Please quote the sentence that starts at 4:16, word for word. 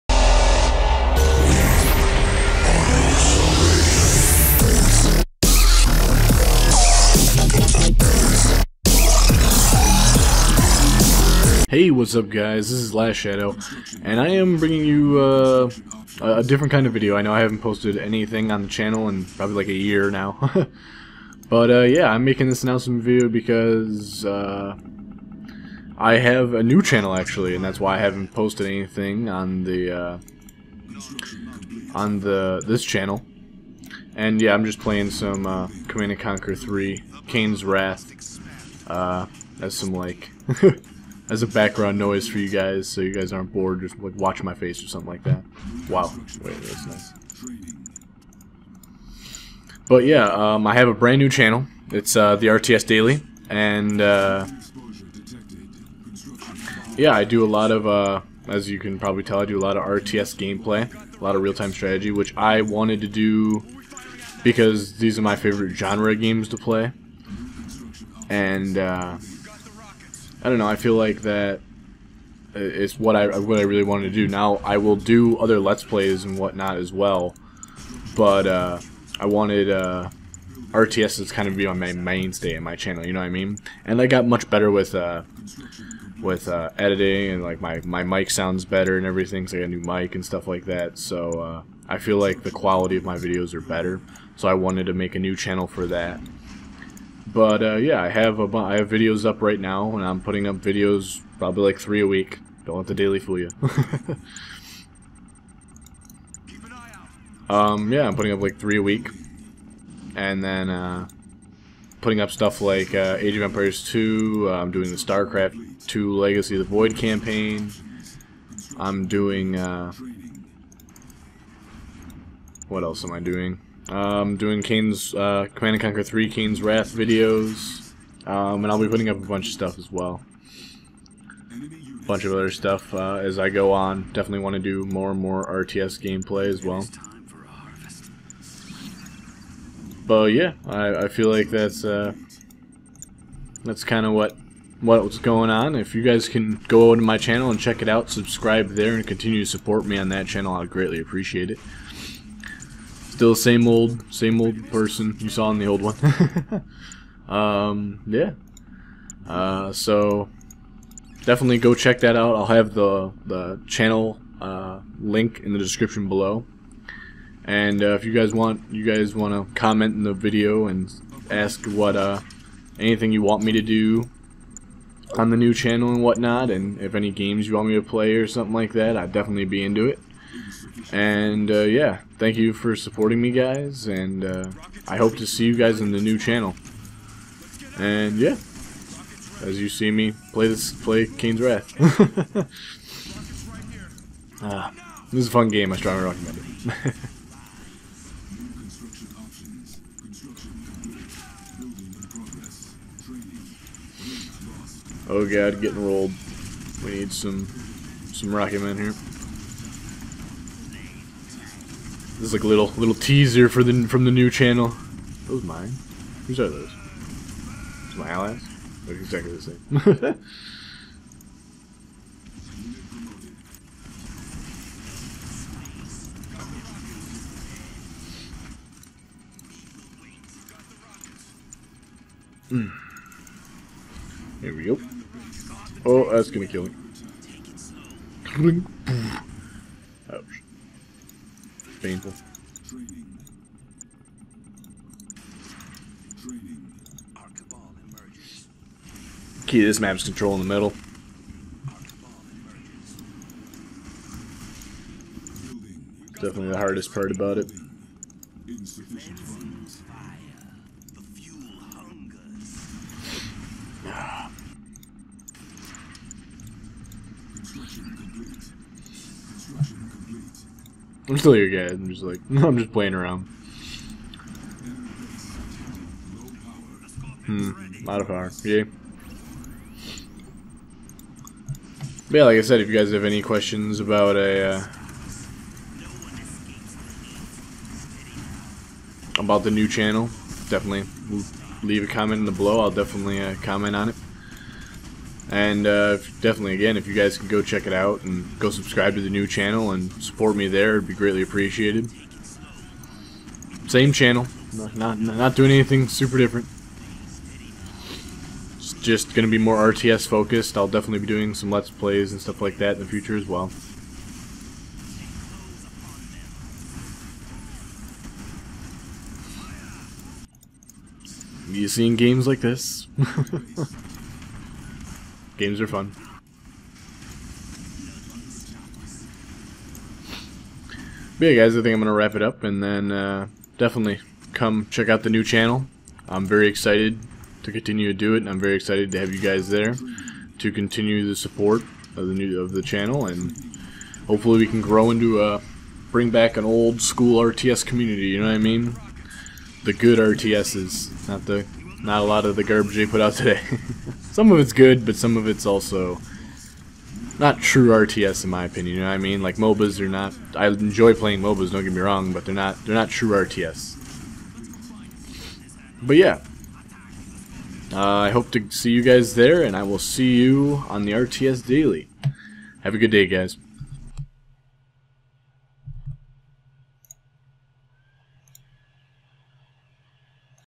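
Definitely the hardest part about it.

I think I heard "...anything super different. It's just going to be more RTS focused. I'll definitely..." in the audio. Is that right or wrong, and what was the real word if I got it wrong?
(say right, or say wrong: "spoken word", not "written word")
right.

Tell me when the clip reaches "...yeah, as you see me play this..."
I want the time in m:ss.
3:08.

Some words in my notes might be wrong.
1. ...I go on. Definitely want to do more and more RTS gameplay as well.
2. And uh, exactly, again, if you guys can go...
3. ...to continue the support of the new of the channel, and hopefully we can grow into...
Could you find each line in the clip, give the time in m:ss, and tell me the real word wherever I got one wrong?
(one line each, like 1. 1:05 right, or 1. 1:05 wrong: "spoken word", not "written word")
1. 2:13 right
2. 4:55 wrong: "definitely", not "exactly"
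3. 5:40 right.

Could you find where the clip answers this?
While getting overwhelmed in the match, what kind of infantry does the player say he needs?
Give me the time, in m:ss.
3:28.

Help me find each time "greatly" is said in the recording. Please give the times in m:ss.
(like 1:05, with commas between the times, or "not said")
2:30, 5:00.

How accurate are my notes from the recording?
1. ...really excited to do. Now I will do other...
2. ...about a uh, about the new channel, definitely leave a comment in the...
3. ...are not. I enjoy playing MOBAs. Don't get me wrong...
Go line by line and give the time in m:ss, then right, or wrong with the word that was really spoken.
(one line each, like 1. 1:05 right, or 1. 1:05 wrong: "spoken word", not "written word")
1. 1:13 wrong: "wanted", not "excited"
2. 4:43 right
3. 5:59 right.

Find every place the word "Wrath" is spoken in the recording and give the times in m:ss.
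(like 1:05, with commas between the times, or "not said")
0:37, 2:06, 3:11.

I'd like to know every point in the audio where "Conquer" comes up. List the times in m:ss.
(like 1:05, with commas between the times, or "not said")
0:36, 2:05.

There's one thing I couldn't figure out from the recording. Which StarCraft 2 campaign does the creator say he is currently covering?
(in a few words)
Legacy of the Void.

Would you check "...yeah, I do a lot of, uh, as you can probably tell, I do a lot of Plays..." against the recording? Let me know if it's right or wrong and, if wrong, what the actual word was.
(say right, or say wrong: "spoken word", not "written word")
wrong: "RTS", not "Plays".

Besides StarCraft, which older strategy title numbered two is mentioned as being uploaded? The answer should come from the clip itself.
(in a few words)
Age of Empires 2.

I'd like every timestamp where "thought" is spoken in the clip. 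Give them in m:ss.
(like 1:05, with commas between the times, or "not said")
not said.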